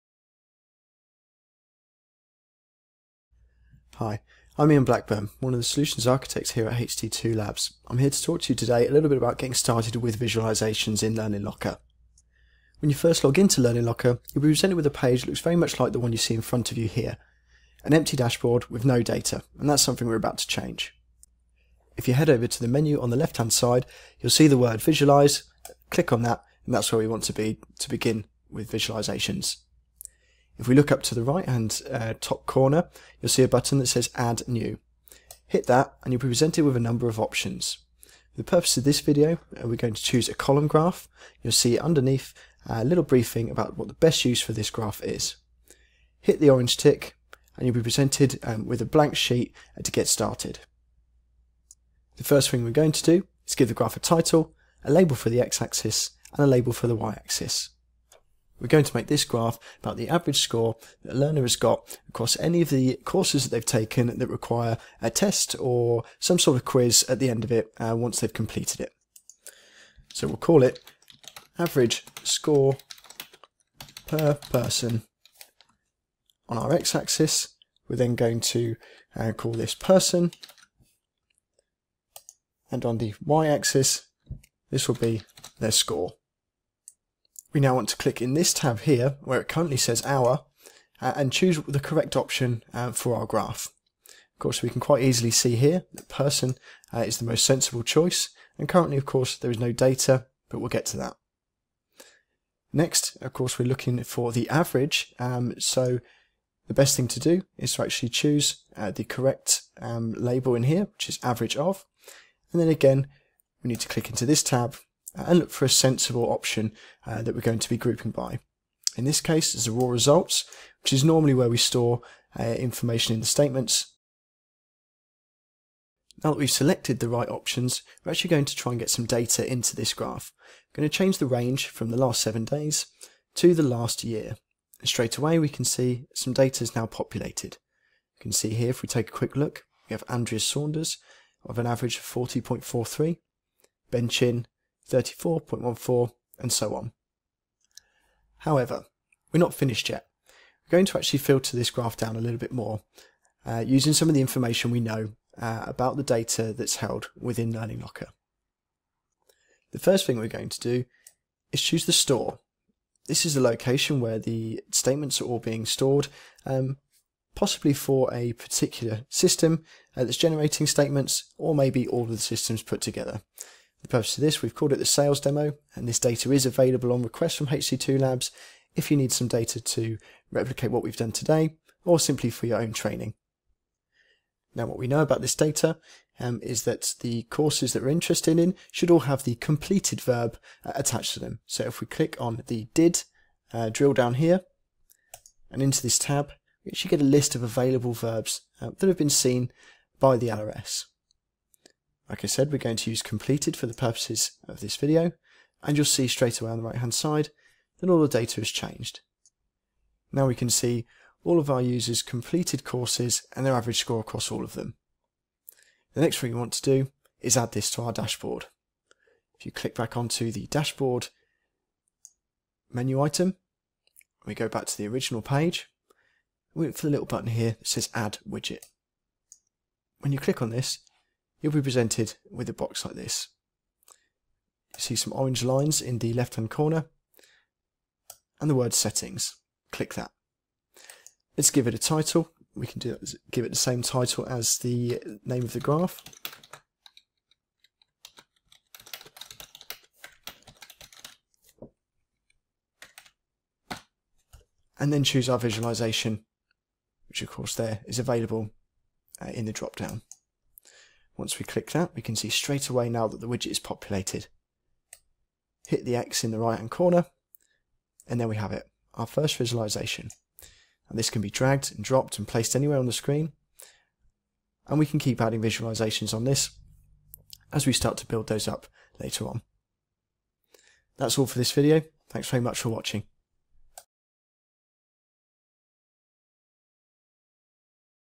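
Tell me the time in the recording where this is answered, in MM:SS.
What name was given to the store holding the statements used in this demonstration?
02:54.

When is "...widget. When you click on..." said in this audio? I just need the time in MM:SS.
03:48.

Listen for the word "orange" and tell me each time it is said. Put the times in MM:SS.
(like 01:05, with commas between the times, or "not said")
00:46, 03:55.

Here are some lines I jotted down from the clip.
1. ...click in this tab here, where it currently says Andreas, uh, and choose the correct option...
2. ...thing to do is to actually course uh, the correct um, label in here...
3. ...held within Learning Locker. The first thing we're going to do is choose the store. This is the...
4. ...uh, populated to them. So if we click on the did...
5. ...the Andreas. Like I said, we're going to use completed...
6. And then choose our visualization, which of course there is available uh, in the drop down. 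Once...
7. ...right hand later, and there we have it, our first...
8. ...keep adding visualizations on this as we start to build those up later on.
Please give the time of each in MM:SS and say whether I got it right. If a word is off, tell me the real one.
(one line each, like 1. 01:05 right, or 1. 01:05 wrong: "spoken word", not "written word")
1. 01:27 wrong: "Hour", not "Andreas"
2. 01:46 wrong: "choose", not "course"
3. 02:36 right
4. 03:10 wrong: "attached", not "populated"
5. 03:20 wrong: "LRS", not "Andreas"
6. 04:14 right
7. 04:26 wrong: "corner", not "later"
8. 04:34 right.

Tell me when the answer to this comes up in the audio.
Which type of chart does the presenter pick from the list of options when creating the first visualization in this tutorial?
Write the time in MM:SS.
00:40.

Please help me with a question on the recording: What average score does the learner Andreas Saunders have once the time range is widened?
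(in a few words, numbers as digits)
40.43.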